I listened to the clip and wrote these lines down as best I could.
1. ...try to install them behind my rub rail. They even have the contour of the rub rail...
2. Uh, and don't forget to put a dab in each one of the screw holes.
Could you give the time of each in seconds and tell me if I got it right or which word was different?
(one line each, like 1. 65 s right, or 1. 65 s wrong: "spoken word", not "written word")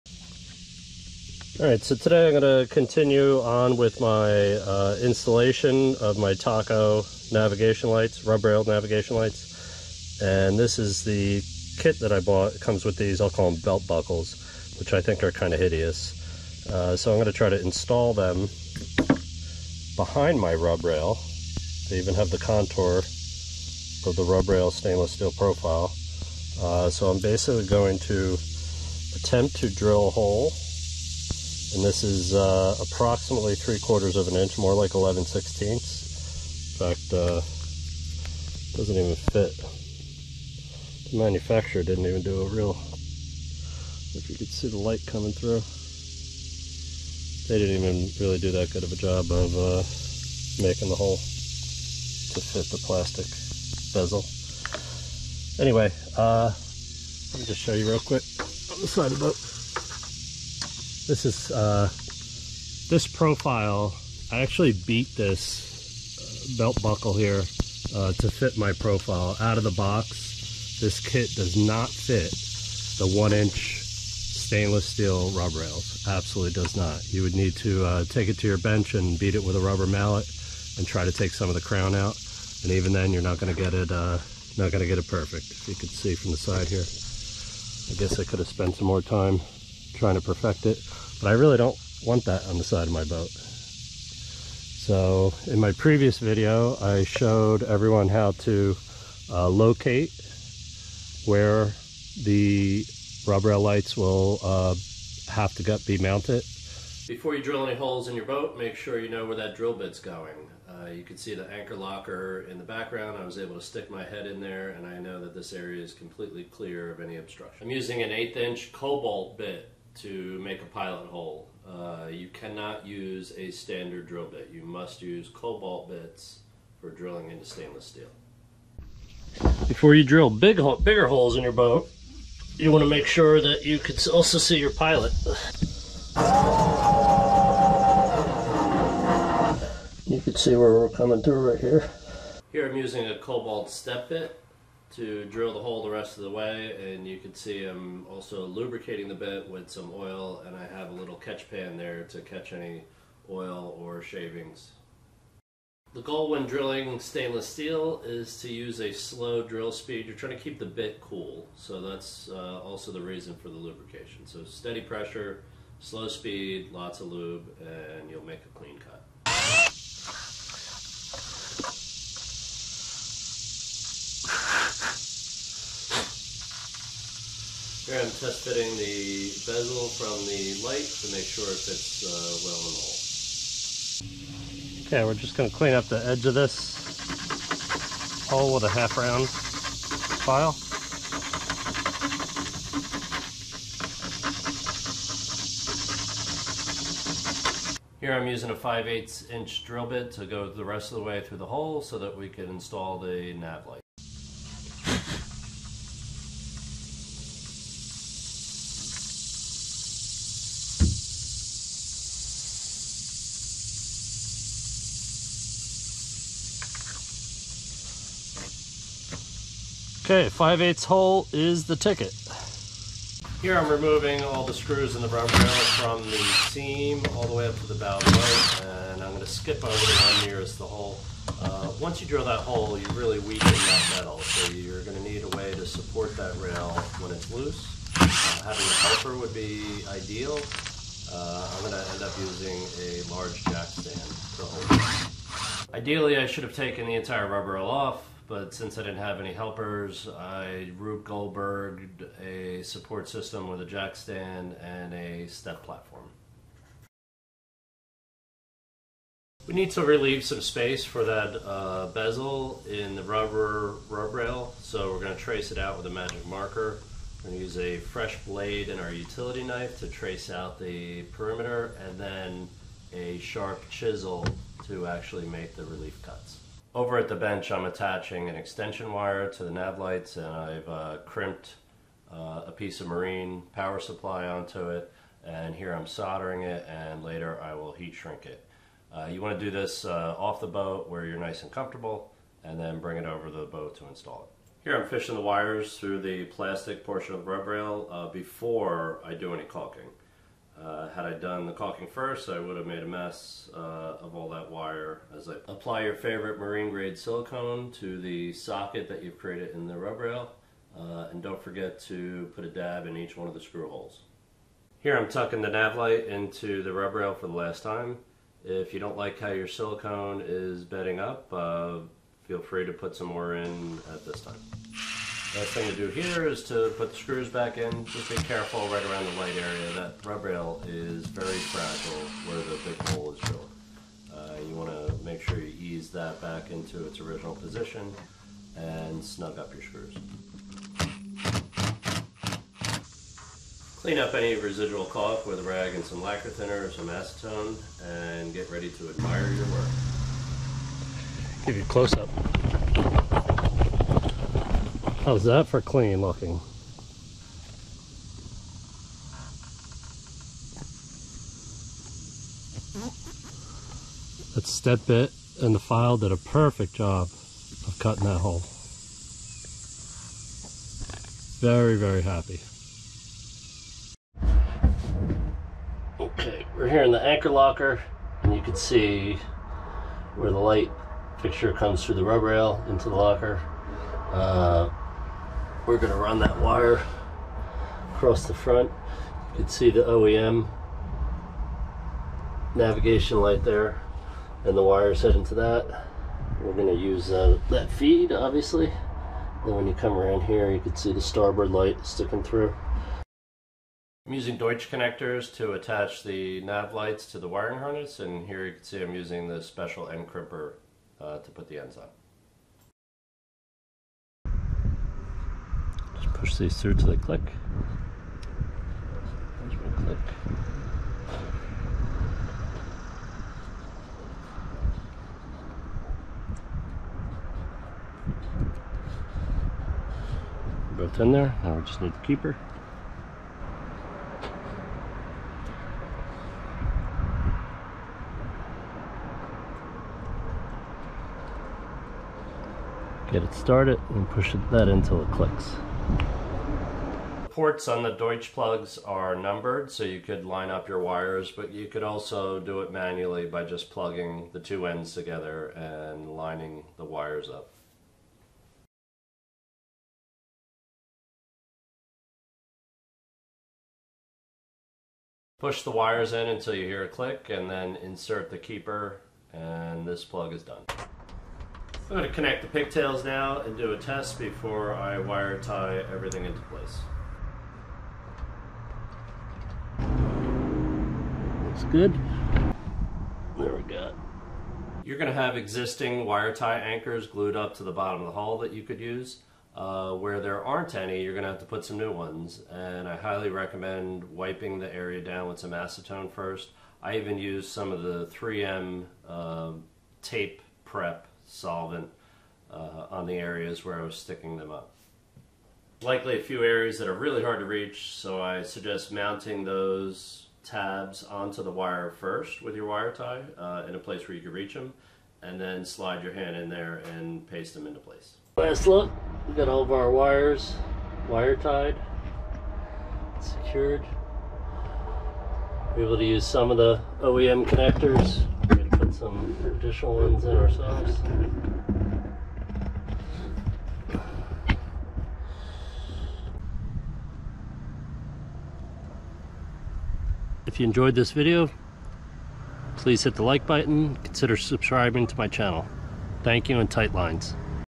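1. 17 s right
2. 310 s right.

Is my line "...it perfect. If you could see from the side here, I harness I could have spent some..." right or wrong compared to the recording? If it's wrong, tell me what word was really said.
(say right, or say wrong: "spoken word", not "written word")
wrong: "guess", not "harness".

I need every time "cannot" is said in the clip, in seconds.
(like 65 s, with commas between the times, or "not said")
122 s.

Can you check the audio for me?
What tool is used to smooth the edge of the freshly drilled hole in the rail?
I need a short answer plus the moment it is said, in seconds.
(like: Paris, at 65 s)
half round file, at 188 s.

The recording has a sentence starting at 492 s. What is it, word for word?
And I highly recommend wiping the area down with some acetone first.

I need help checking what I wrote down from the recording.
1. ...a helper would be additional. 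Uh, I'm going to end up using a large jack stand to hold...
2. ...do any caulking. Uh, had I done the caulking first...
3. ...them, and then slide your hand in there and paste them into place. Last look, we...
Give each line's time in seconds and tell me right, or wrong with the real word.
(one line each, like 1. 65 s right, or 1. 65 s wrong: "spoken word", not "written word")
1. 238 s wrong: "ideal", not "additional"
2. 299 s right
3. 514 s right.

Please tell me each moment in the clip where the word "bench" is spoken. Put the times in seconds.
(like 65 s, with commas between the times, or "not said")
78 s, 277 s.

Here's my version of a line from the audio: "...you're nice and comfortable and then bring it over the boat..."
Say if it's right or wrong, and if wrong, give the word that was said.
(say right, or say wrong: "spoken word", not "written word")
right.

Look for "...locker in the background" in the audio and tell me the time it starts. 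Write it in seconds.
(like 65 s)
111 s.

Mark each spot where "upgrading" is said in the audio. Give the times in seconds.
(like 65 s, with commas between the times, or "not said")
not said.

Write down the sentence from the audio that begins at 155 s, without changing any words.
The goal when drilling stainless steel is to use a slow drill speed.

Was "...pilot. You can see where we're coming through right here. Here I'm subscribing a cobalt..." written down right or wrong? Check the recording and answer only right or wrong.
wrong.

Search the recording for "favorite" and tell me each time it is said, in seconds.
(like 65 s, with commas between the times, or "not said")
305 s.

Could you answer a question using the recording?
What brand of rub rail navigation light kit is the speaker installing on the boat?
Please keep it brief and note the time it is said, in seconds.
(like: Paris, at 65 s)
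Taco, at 6 s.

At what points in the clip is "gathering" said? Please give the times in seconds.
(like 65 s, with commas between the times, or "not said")
not said.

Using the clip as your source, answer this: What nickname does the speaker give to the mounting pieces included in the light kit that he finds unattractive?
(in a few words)
belt buckles.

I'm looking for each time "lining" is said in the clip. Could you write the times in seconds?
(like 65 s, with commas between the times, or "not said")
456 s.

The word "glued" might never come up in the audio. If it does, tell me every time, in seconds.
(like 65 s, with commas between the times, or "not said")
487 s.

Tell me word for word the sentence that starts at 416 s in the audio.
push these through till they click.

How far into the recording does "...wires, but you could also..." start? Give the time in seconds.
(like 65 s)
450 s.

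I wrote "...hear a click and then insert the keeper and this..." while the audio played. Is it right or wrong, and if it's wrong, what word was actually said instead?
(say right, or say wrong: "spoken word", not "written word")
right.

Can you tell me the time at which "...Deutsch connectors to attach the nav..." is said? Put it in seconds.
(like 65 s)
404 s.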